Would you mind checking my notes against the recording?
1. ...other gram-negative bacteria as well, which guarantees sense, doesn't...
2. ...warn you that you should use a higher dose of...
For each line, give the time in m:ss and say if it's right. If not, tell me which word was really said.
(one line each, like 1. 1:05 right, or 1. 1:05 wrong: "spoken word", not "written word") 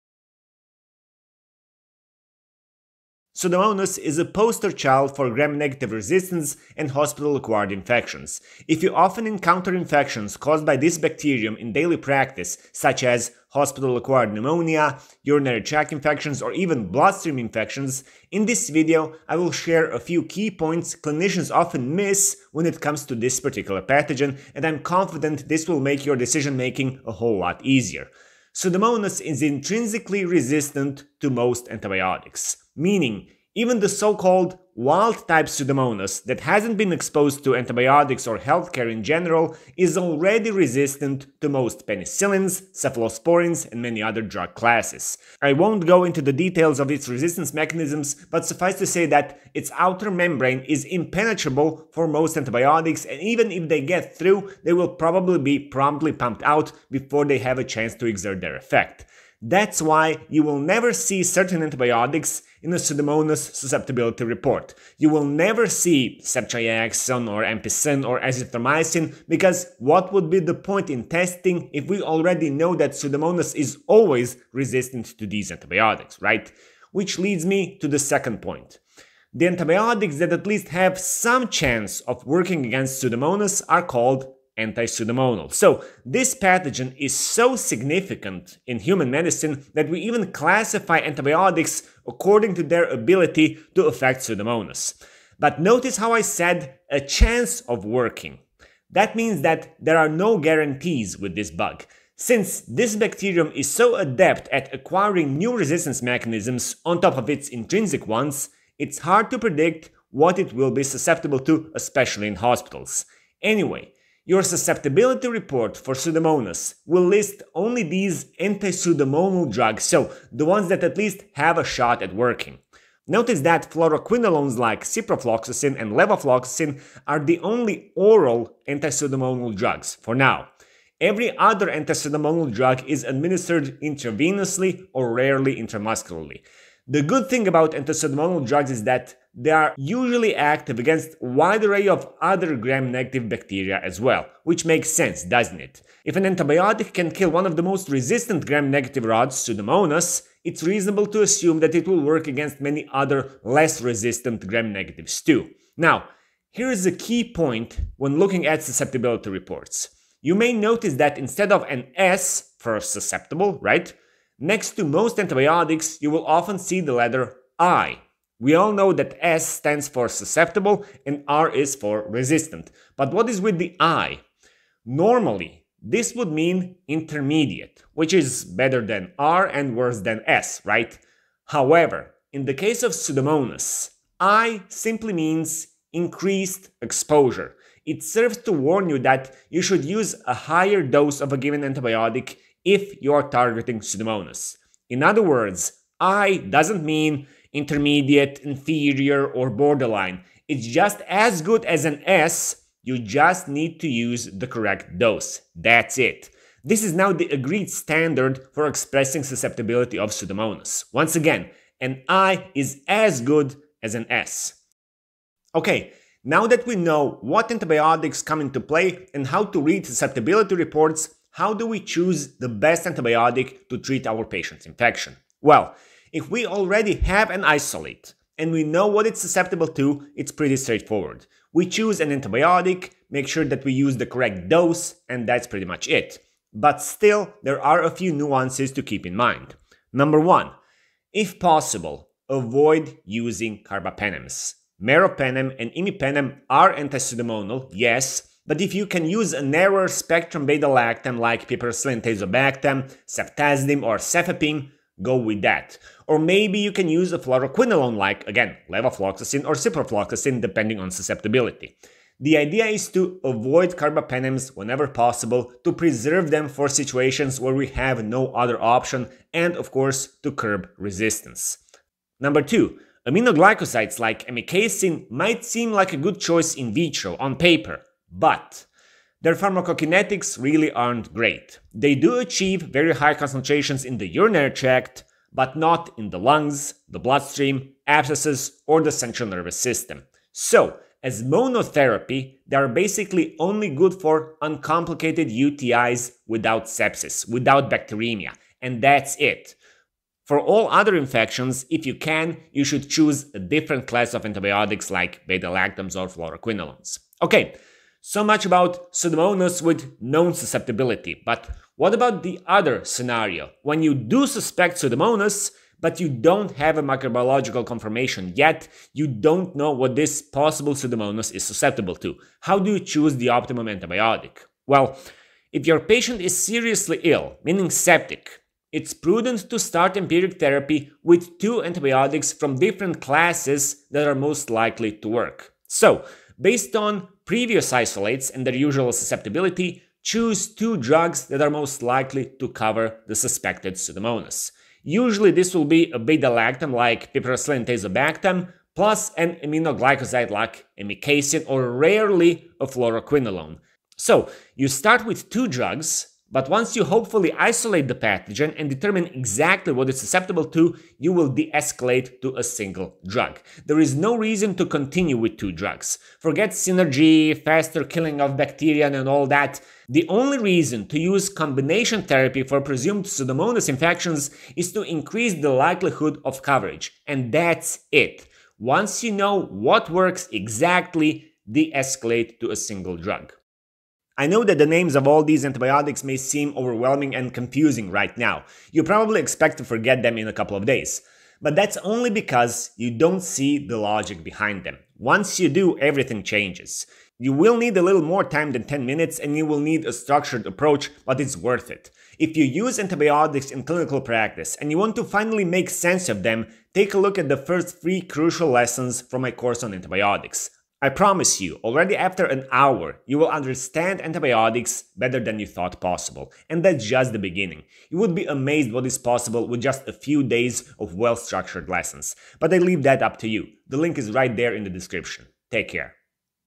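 1. 2:22 wrong: "makes", not "guarantees"
2. 3:08 right.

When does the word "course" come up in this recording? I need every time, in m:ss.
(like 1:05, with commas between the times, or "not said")
4:29, 6:49.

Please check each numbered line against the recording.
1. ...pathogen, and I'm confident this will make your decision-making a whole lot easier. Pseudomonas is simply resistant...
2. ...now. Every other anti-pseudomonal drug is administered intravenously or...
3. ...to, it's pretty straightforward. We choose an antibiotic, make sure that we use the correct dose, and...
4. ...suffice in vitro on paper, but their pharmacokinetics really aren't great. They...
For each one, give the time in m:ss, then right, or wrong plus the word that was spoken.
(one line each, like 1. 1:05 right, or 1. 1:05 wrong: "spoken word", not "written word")
1. 0:23 wrong: "intrinsically", not "simply"
2. 2:10 right
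3. 3:49 right
4. 4:36 wrong: "choice", not "suffice".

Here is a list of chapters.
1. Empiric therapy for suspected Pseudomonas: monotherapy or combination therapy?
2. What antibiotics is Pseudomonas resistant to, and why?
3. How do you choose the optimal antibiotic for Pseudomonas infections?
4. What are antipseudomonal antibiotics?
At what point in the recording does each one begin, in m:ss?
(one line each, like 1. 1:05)
1. 5:08
2. 0:28
3. 3:36
4. 1:19.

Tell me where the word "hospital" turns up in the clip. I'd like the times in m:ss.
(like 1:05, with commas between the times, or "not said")
0:06, 0:13, 1:52.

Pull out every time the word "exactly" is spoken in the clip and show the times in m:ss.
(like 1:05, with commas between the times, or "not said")
5:59, 6:20.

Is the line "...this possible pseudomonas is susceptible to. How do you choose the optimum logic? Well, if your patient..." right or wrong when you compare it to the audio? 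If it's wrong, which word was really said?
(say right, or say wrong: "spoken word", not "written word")
wrong: "antibiotic", not "logic".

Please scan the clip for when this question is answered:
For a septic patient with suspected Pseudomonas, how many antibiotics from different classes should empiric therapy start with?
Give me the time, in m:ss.
5:31.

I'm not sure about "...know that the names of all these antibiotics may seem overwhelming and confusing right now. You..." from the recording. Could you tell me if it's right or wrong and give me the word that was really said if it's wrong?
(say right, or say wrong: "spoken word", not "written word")
right.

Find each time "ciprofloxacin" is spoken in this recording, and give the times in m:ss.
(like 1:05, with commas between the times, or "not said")
2:04, 4:19.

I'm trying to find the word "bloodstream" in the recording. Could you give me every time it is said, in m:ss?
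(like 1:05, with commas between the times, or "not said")
0:16, 4:46.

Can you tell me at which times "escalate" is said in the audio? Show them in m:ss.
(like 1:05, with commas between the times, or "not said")
6:01, 6:21.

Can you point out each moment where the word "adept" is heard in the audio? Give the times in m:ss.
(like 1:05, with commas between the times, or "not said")
1:43.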